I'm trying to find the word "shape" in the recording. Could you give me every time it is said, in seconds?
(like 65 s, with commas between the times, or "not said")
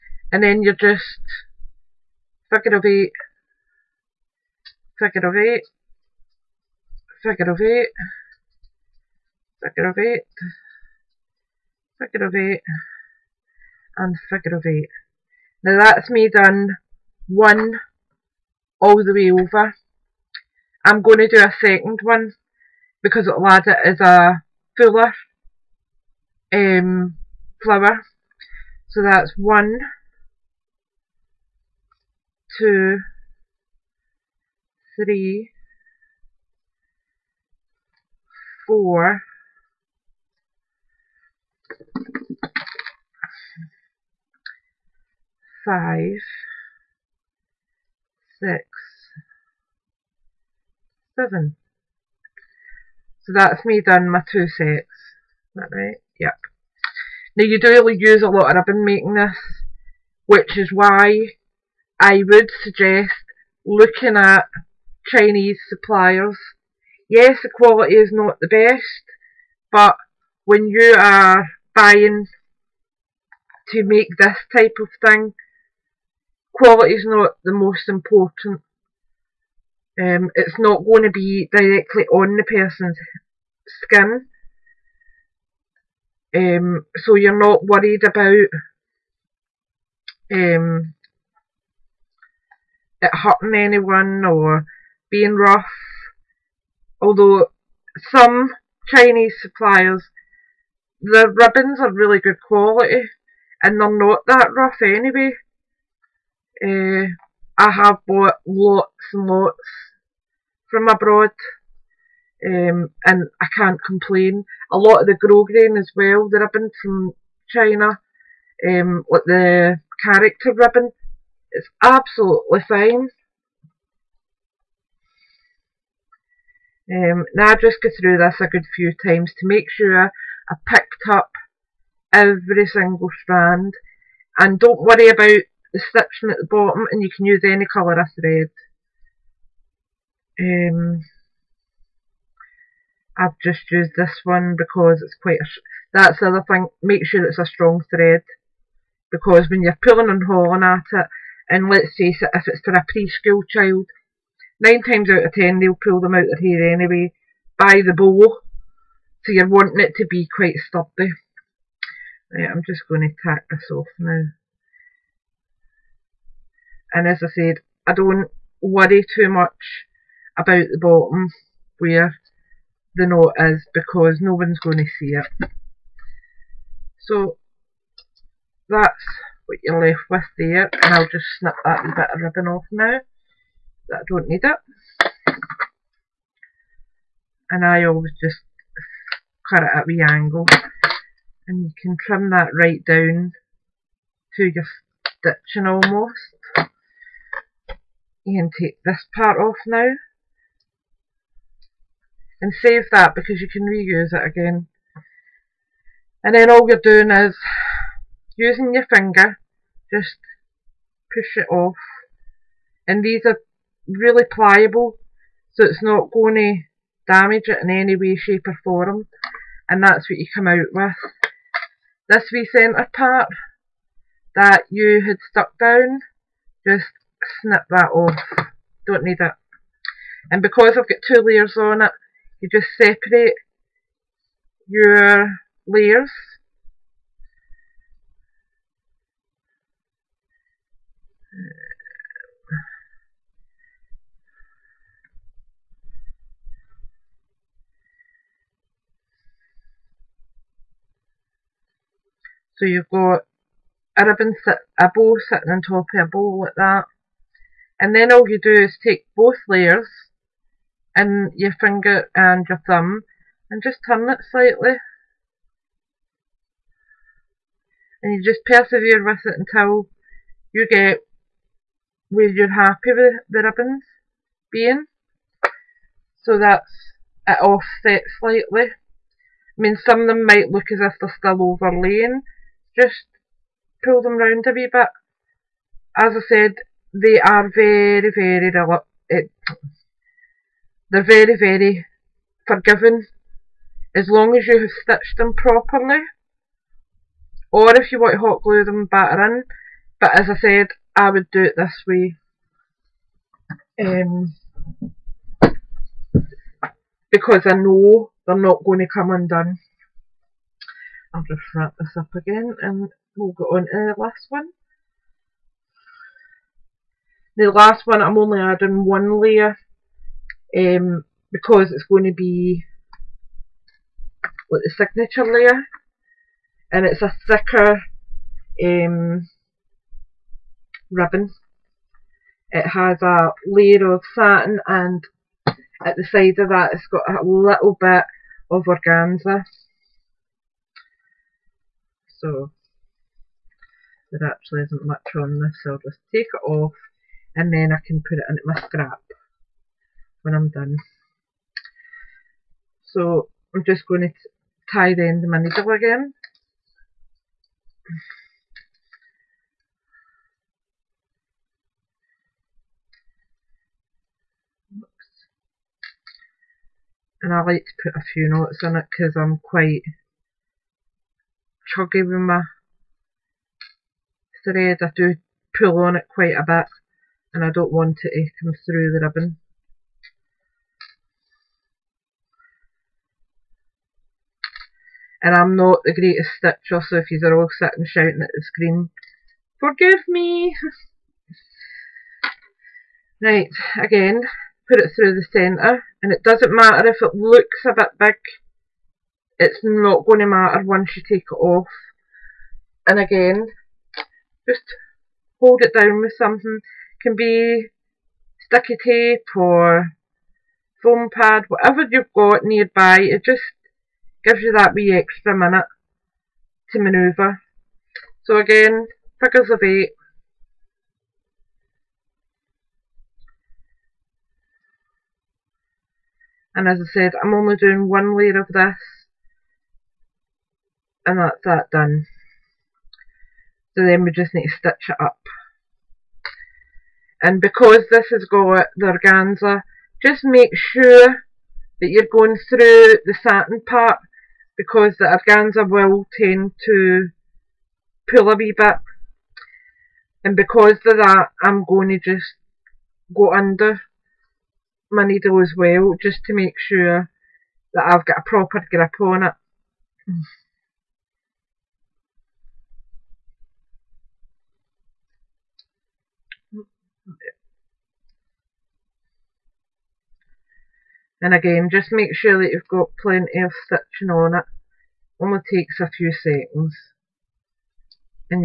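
218 s.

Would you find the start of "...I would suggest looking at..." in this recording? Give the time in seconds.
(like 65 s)
61 s.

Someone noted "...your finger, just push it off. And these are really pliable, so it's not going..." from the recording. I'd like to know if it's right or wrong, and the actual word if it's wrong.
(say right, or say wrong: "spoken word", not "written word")
right.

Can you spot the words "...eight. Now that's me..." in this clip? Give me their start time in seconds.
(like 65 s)
14 s.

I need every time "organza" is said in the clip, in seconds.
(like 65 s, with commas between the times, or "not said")
338 s, 438 s, 445 s.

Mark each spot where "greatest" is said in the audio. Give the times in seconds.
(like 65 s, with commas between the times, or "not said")
385 s.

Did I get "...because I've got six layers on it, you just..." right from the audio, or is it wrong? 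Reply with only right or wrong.
wrong.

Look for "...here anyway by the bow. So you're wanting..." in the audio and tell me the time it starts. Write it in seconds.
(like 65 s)
156 s.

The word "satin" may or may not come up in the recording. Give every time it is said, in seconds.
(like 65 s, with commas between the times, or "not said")
334 s, 443 s.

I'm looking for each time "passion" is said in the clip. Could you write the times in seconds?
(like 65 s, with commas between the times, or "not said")
not said.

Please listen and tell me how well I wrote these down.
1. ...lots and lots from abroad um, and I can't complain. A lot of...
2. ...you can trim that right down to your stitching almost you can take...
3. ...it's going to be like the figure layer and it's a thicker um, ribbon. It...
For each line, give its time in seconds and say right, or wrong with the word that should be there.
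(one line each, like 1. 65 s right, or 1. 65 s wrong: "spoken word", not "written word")
1. 108 s right
2. 191 s right
3. 321 s wrong: "signature", not "figure".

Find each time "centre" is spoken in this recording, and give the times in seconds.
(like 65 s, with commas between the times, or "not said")
222 s, 395 s.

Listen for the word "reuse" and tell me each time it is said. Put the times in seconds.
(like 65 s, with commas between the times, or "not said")
203 s.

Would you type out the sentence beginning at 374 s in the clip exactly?
I do pull on it quite a bit and I don't want it to come through the ribbon.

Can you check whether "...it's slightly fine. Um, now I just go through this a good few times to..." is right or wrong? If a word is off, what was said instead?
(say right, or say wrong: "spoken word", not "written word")
wrong: "absolutely", not "slightly".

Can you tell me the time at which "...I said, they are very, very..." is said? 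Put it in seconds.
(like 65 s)
286 s.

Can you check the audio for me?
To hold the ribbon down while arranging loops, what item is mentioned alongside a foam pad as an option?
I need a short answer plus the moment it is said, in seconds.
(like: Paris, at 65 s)
sticky tape, at 408 s.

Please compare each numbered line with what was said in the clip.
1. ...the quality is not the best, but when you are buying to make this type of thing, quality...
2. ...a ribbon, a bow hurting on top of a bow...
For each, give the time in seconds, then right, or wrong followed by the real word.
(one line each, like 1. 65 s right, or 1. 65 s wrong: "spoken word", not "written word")
1. 67 s right
2. 253 s wrong: "sitting", not "hurting".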